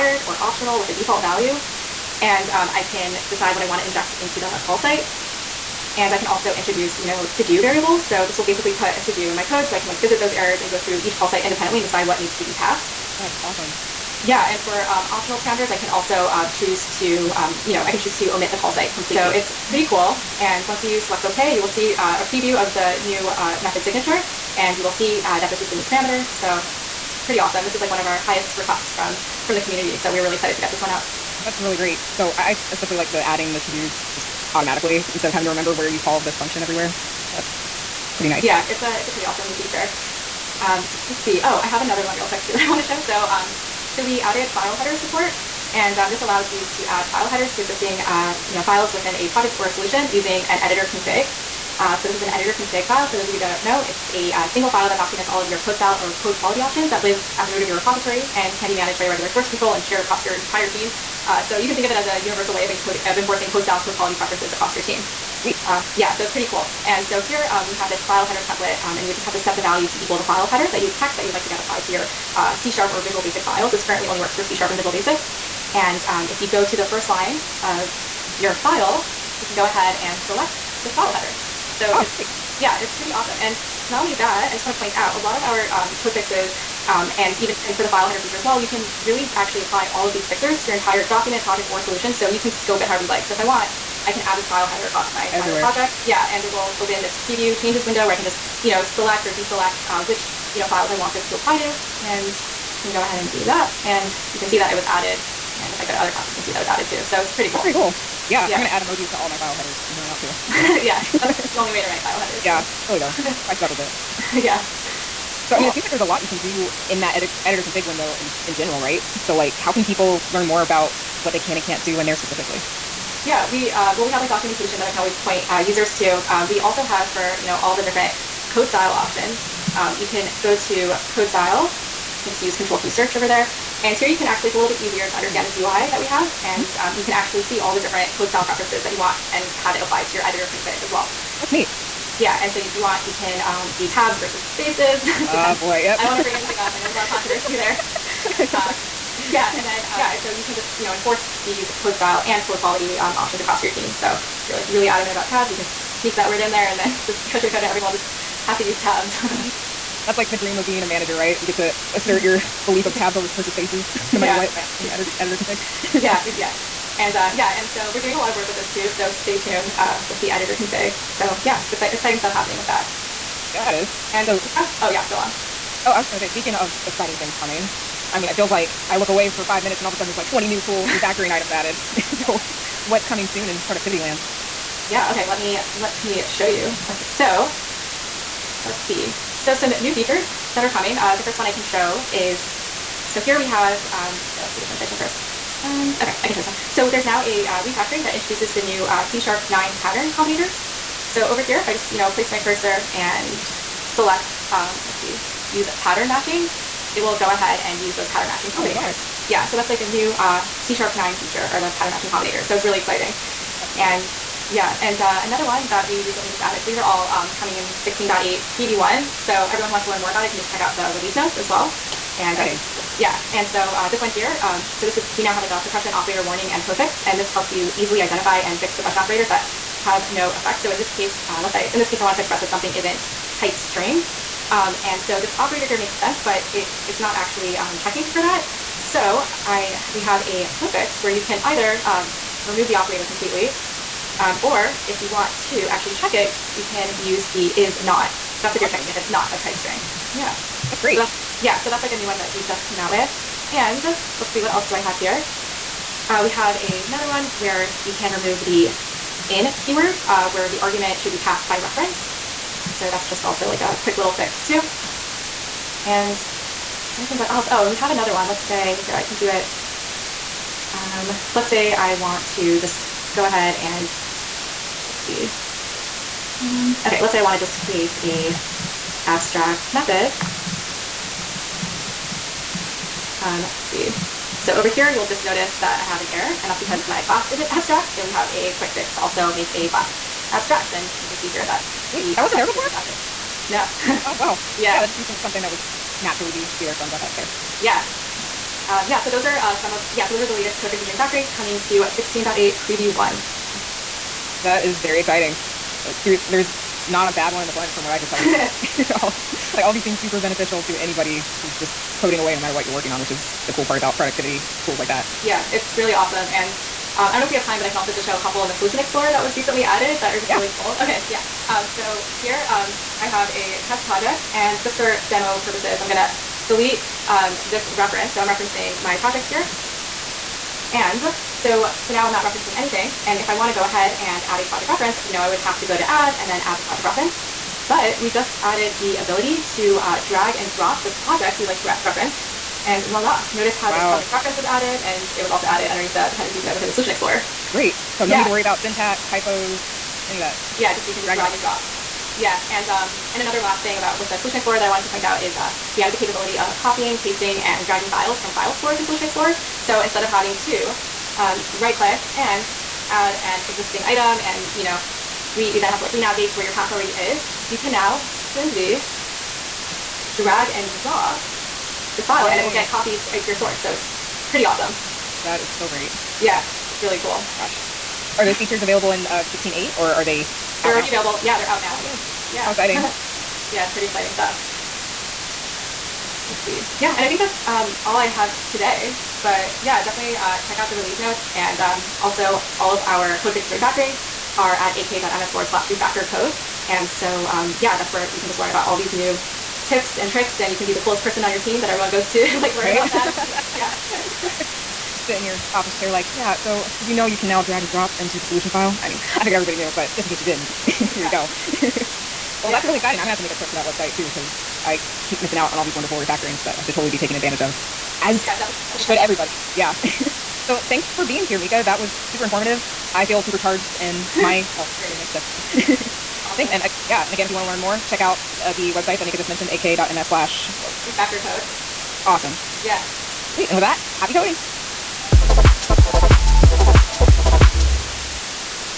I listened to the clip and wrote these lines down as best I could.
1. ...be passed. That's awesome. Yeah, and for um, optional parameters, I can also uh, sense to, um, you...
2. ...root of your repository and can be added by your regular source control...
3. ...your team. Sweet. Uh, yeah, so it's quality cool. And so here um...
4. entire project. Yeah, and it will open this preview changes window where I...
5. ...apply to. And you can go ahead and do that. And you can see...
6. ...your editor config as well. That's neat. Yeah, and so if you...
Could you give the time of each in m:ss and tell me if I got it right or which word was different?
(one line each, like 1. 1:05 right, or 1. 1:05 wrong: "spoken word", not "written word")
1. 0:12 wrong: "choose", not "sense"
2. 0:57 wrong: "managed", not "added"
3. 1:04 wrong: "pretty", not "quality"
4. 1:35 right
5. 1:41 right
6. 2:20 right.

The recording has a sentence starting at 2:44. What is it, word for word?
what by the editor, editor config.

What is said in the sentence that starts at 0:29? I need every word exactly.
So we were really excited to get this one out.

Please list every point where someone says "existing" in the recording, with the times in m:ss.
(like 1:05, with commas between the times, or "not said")
0:47, 6:03.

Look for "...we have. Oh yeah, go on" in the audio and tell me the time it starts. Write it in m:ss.
2:54.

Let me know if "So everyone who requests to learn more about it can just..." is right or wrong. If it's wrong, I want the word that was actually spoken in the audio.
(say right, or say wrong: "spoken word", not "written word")
wrong: "wants", not "requests".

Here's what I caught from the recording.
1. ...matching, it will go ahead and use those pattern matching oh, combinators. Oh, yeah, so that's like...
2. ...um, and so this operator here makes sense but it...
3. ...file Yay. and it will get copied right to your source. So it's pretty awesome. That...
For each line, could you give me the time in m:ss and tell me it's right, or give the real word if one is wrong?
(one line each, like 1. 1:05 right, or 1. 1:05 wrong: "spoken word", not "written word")
1. 3:26 right
2. 3:54 right
3. 6:12 right.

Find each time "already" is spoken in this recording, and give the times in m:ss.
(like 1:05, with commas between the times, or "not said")
6:06, 6:20.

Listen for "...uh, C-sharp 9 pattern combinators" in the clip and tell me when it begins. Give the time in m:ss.
3:18.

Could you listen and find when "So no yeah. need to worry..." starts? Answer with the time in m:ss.
5:47.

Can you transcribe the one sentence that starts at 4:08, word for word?
That's if you're checking if it's not of type string.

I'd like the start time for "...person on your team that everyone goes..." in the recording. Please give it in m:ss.
6:41.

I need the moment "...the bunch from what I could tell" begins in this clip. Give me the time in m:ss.
5:07.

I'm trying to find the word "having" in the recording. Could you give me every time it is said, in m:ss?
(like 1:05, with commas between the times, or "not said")
0:35, 6:00.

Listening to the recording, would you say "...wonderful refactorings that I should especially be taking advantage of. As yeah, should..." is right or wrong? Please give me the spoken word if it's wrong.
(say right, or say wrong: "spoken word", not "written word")
wrong: "totally", not "especially".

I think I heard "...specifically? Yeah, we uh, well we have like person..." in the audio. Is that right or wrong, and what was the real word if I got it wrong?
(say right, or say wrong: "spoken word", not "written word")
wrong: "documentation", not "person".